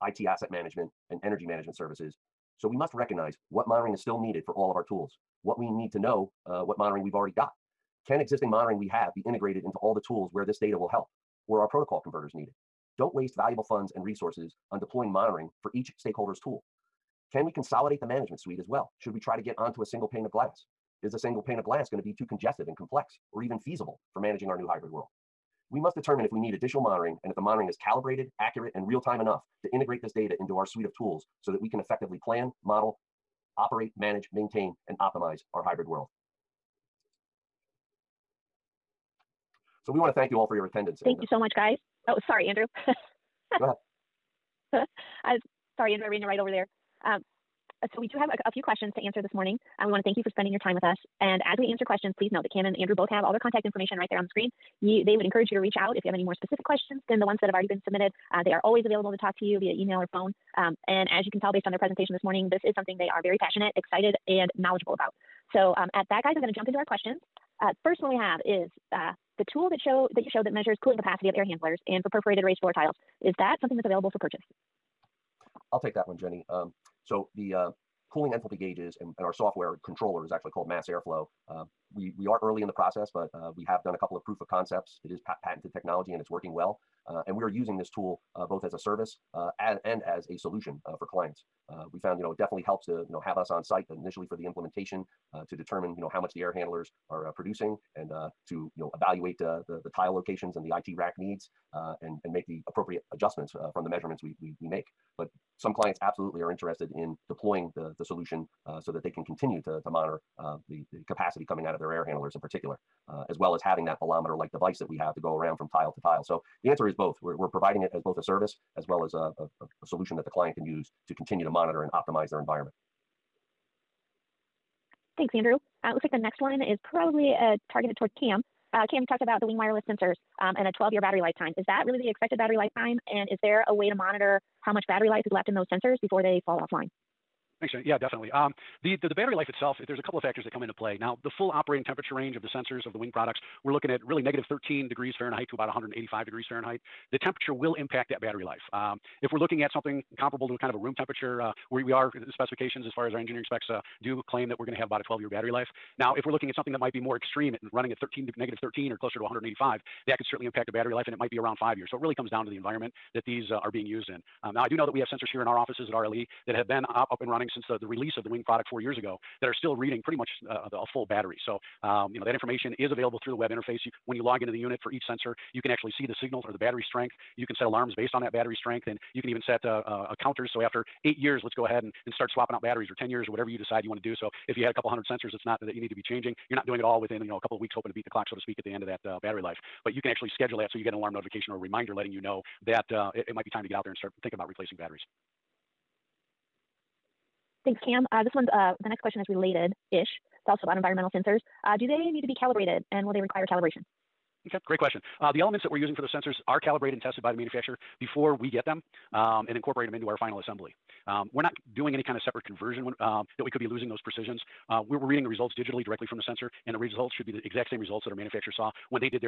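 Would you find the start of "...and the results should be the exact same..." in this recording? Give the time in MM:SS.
03:36.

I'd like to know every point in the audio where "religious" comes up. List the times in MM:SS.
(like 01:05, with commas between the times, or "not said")
not said.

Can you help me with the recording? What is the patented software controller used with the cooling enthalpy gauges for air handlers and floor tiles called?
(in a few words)
Mass airflow.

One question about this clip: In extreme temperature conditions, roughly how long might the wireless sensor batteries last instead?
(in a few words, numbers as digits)
5 years.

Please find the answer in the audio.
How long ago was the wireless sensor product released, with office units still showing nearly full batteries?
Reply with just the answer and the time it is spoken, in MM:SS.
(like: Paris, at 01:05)
4 years, at 02:48.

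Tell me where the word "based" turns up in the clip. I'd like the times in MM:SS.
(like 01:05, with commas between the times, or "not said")
01:01, 02:57.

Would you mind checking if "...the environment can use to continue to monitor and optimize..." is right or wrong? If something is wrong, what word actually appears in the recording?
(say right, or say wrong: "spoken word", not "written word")
wrong: "client", not "environment".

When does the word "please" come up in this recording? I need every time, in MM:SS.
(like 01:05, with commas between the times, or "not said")
00:52.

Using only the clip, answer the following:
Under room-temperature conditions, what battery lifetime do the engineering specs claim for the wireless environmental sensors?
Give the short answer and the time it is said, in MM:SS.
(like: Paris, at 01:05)
12 years, at 02:35.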